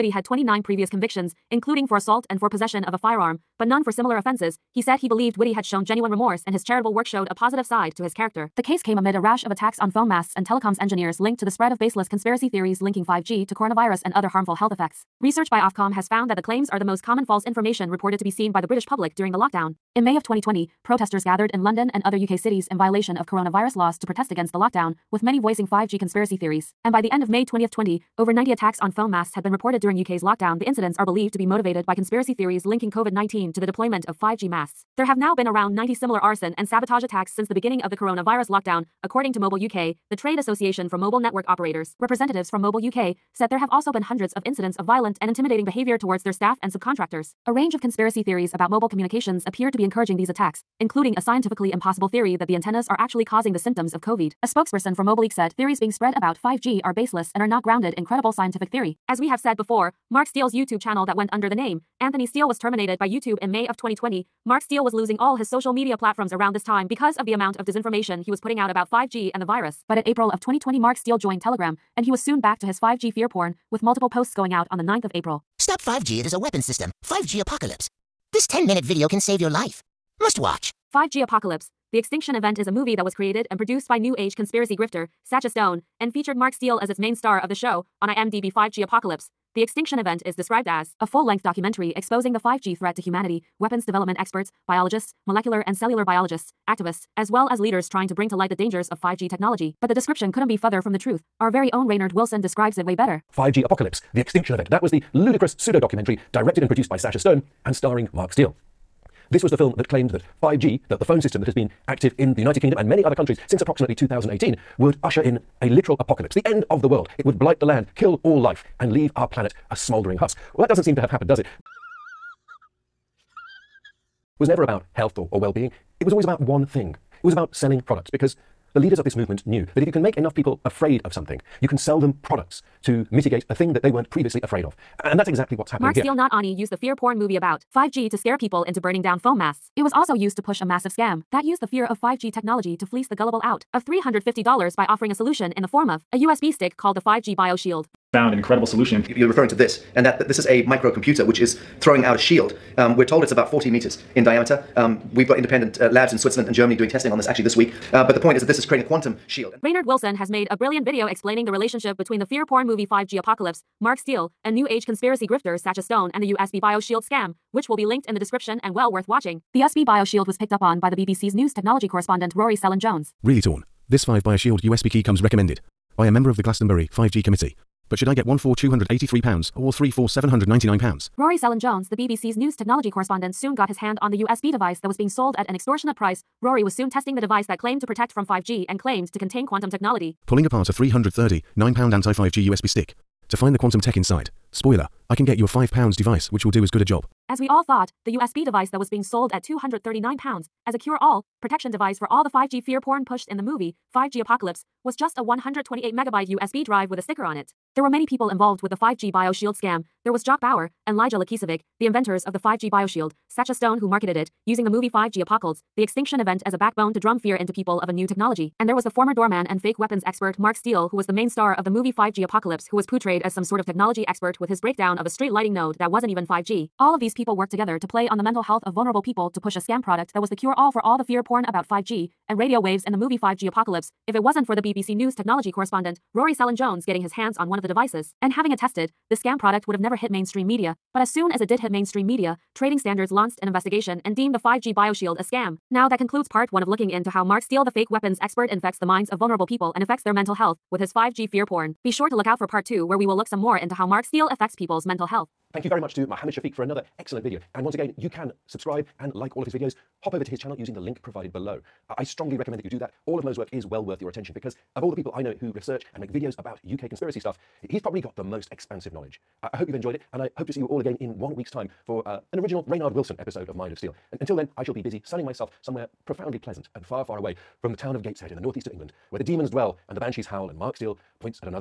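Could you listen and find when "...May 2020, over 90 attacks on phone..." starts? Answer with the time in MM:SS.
00:27.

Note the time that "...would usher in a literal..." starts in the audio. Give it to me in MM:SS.
01:54.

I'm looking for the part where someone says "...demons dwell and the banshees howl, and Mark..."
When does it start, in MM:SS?
04:39.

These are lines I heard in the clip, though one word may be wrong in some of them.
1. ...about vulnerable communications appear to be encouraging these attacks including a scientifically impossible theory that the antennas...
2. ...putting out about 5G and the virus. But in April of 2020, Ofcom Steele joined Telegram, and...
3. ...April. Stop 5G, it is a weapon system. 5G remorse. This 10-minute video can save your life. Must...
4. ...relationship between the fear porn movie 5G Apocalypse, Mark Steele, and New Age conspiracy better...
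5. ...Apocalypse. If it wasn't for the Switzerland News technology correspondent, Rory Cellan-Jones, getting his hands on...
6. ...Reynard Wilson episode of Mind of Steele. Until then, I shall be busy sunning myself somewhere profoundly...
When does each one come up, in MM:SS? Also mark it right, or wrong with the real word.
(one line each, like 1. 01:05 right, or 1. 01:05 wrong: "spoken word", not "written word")
1. 00:48 wrong: "mobile", not "vulnerable"
2. 01:08 wrong: "Mark", not "Ofcom"
3. 01:15 wrong: "apocalypse", not "remorse"
4. 02:41 wrong: "grifter", not "better"
5. 03:53 wrong: "BBC", not "Switzerland"
6. 04:32 right.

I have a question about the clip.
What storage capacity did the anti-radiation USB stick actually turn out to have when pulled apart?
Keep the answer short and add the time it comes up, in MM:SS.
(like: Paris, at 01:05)
128 megabytes, at 03:25.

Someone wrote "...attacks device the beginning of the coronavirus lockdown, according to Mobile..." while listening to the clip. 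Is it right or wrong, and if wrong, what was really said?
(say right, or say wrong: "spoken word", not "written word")
wrong: "since", not "device".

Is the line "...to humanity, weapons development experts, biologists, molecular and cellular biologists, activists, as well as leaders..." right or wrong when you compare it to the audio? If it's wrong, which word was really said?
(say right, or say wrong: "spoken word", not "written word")
right.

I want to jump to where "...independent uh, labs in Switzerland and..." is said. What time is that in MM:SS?
02:35.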